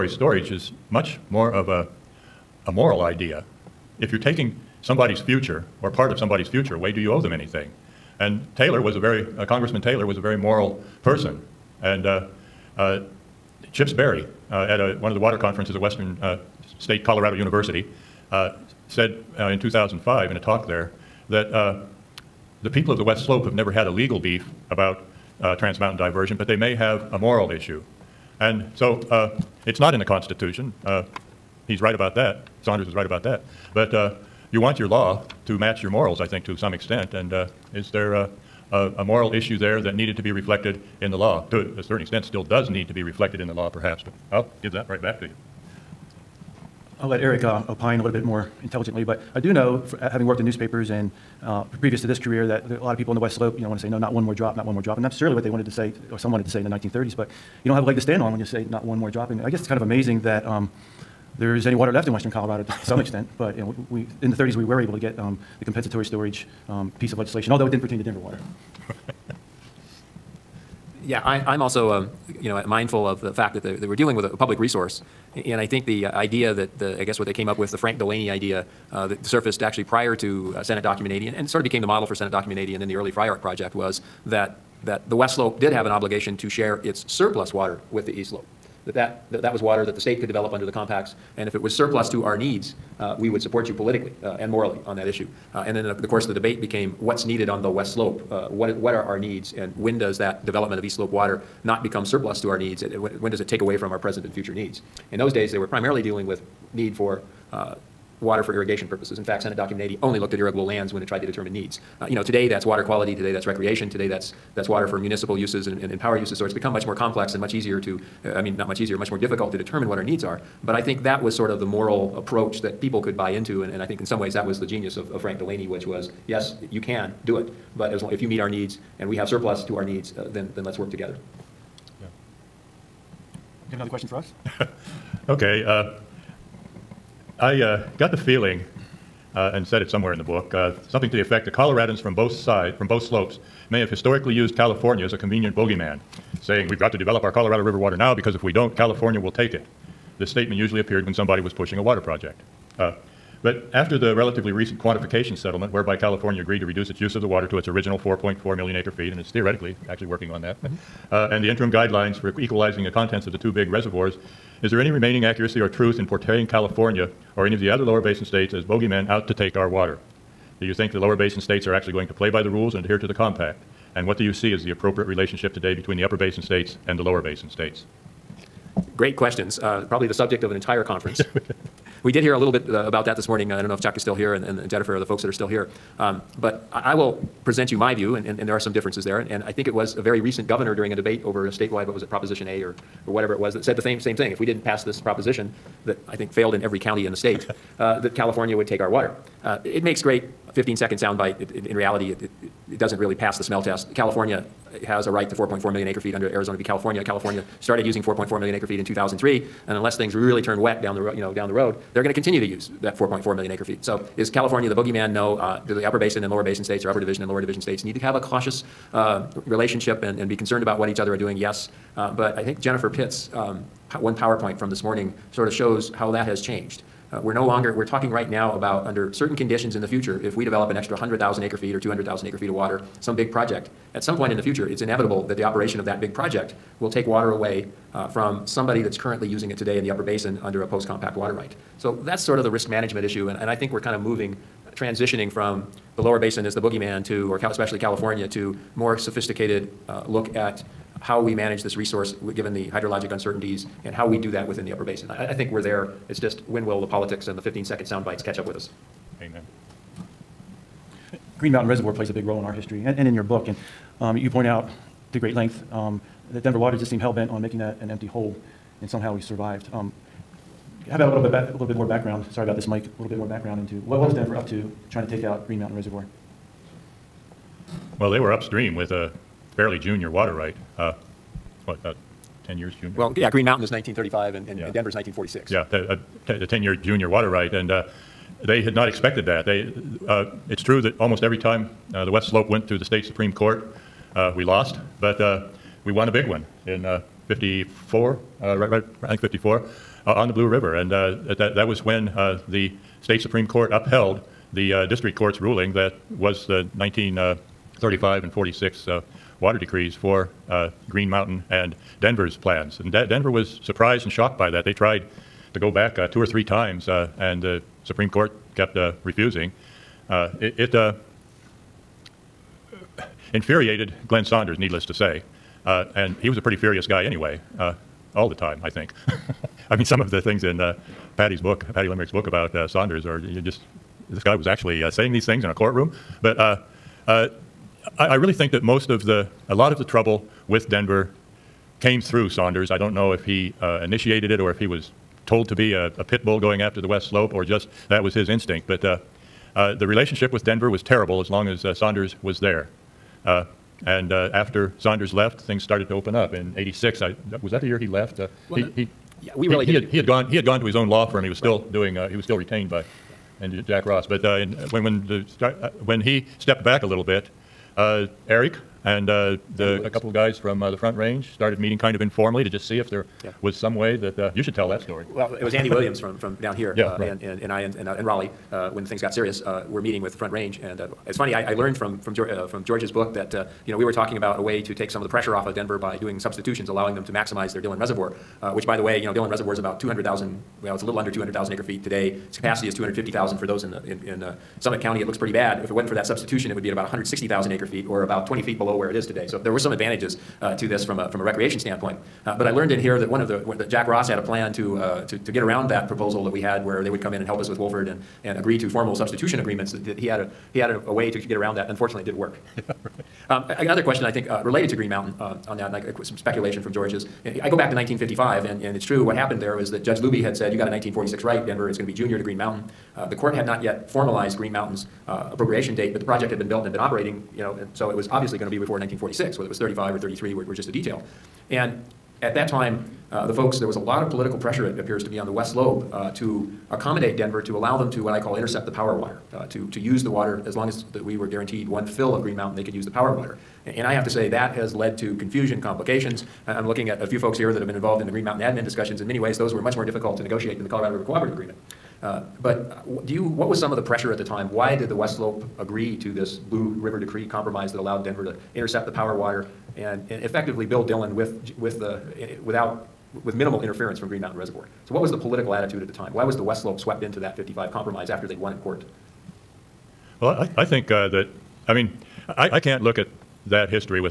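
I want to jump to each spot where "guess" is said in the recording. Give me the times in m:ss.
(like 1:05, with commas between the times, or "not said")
0:59, 1:17.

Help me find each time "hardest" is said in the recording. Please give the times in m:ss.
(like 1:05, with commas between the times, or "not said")
not said.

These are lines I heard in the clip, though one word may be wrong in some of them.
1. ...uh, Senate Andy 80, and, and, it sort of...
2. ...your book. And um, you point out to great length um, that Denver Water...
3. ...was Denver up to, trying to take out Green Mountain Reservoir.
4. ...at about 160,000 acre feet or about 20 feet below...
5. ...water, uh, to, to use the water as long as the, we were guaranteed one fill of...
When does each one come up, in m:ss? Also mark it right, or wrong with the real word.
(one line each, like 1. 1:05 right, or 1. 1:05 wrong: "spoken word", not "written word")
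1. 1:20 wrong: "Document", not "Andy"
2. 4:23 right
3. 4:34 right
4. 6:36 right
5. 7:18 right.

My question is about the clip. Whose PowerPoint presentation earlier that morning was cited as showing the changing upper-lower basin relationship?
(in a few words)
Jennifer Pitt.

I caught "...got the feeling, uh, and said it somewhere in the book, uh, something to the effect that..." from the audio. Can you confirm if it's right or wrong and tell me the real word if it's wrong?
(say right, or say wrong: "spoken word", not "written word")
right.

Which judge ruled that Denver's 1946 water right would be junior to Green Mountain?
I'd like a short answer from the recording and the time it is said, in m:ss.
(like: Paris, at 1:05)
Judge Luby, at 6:59.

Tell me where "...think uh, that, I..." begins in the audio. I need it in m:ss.
7:50.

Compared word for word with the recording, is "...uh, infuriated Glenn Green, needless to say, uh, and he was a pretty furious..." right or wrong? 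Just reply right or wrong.
wrong.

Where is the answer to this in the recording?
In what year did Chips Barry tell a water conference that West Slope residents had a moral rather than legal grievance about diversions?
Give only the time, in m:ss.
0:19.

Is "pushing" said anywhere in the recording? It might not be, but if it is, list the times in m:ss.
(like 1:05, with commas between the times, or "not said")
2:31.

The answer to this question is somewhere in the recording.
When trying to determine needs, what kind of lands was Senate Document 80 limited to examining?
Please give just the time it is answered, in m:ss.
1:50.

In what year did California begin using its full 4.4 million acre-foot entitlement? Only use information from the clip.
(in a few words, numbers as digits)
2003.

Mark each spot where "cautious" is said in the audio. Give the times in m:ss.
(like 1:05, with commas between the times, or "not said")
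3:38.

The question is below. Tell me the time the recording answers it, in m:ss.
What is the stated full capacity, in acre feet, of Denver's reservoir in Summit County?
6:32.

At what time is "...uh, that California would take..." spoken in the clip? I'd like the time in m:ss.
3:17.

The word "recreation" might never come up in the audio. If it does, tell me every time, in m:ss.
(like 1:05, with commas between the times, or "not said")
1:53, 6:41.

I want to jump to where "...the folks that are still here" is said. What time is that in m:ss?
3:04.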